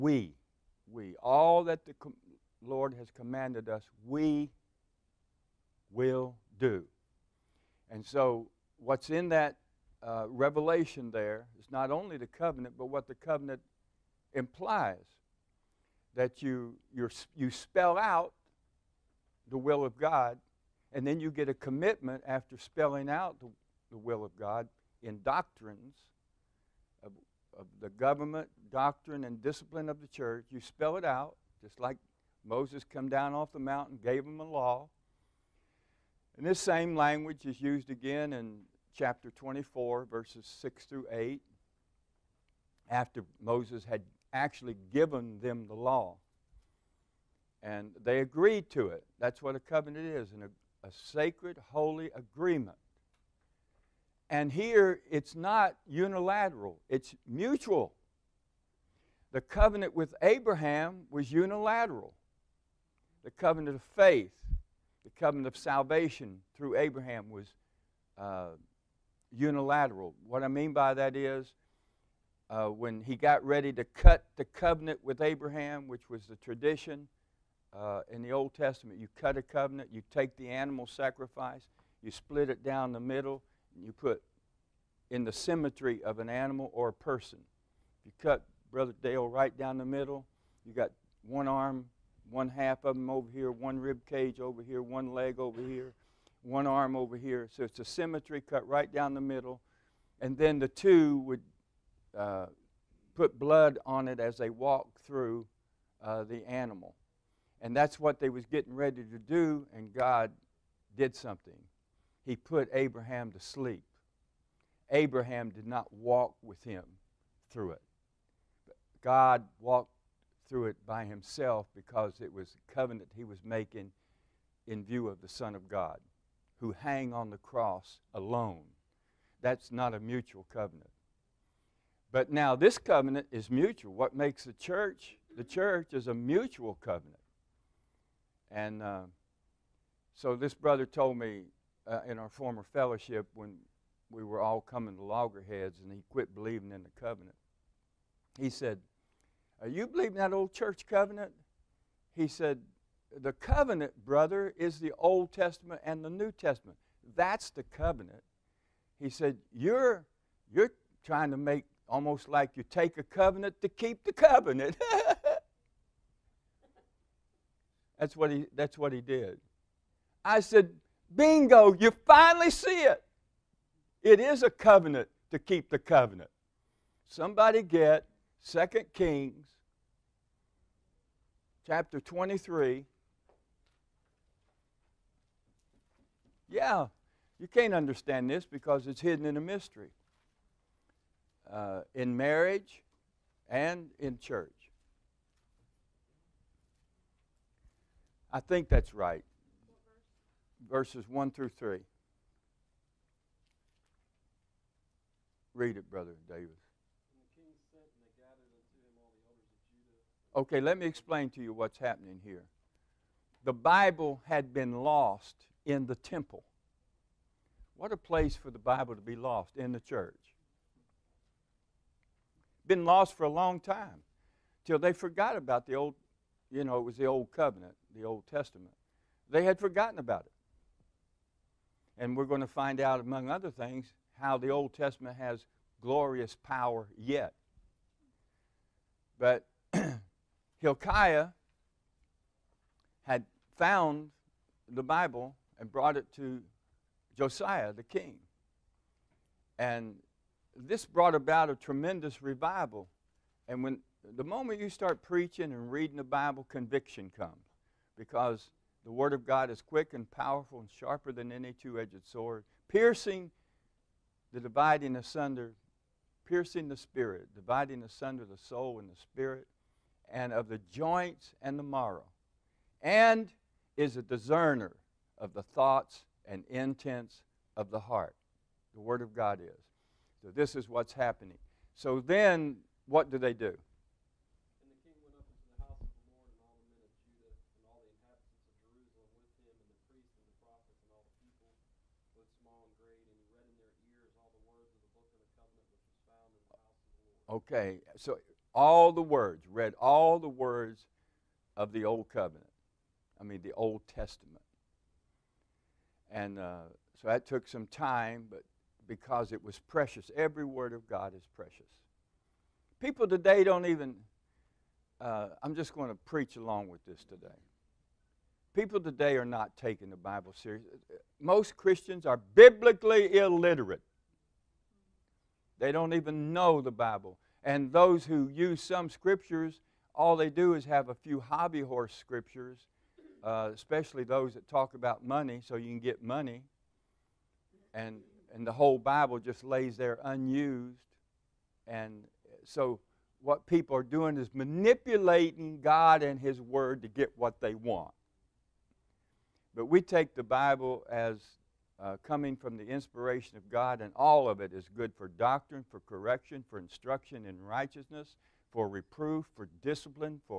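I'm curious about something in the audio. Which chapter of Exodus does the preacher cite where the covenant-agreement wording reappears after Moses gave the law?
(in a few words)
Chapter 24.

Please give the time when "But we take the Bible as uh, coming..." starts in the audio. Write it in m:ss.
5:49.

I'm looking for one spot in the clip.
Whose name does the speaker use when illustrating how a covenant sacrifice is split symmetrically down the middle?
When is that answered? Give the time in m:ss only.
1:28.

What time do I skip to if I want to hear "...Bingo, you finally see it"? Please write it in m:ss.
2:51.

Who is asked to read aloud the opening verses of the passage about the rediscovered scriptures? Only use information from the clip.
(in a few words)
Brother Davis.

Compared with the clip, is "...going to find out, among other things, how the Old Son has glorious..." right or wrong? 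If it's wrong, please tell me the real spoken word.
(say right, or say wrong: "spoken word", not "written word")
wrong: "Testament", not "Son".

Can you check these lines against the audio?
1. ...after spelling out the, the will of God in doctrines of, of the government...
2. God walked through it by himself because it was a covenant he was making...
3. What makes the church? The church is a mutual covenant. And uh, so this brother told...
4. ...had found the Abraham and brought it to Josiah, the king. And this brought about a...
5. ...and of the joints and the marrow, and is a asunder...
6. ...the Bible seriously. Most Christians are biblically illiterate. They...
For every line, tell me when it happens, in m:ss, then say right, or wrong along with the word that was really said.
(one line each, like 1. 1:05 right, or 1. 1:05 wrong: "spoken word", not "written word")
1. 0:22 right
2. 1:59 right
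3. 2:13 right
4. 4:03 wrong: "Bible", not "Abraham"
5. 4:30 wrong: "discerner", not "asunder"
6. 5:19 right.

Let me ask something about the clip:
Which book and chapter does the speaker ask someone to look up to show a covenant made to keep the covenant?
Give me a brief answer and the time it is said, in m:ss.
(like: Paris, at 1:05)
Second Kings 23, at 2:58.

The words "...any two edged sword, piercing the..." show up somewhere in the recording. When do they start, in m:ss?
4:21.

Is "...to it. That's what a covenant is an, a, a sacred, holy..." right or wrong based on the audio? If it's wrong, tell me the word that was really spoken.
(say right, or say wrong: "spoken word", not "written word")
right.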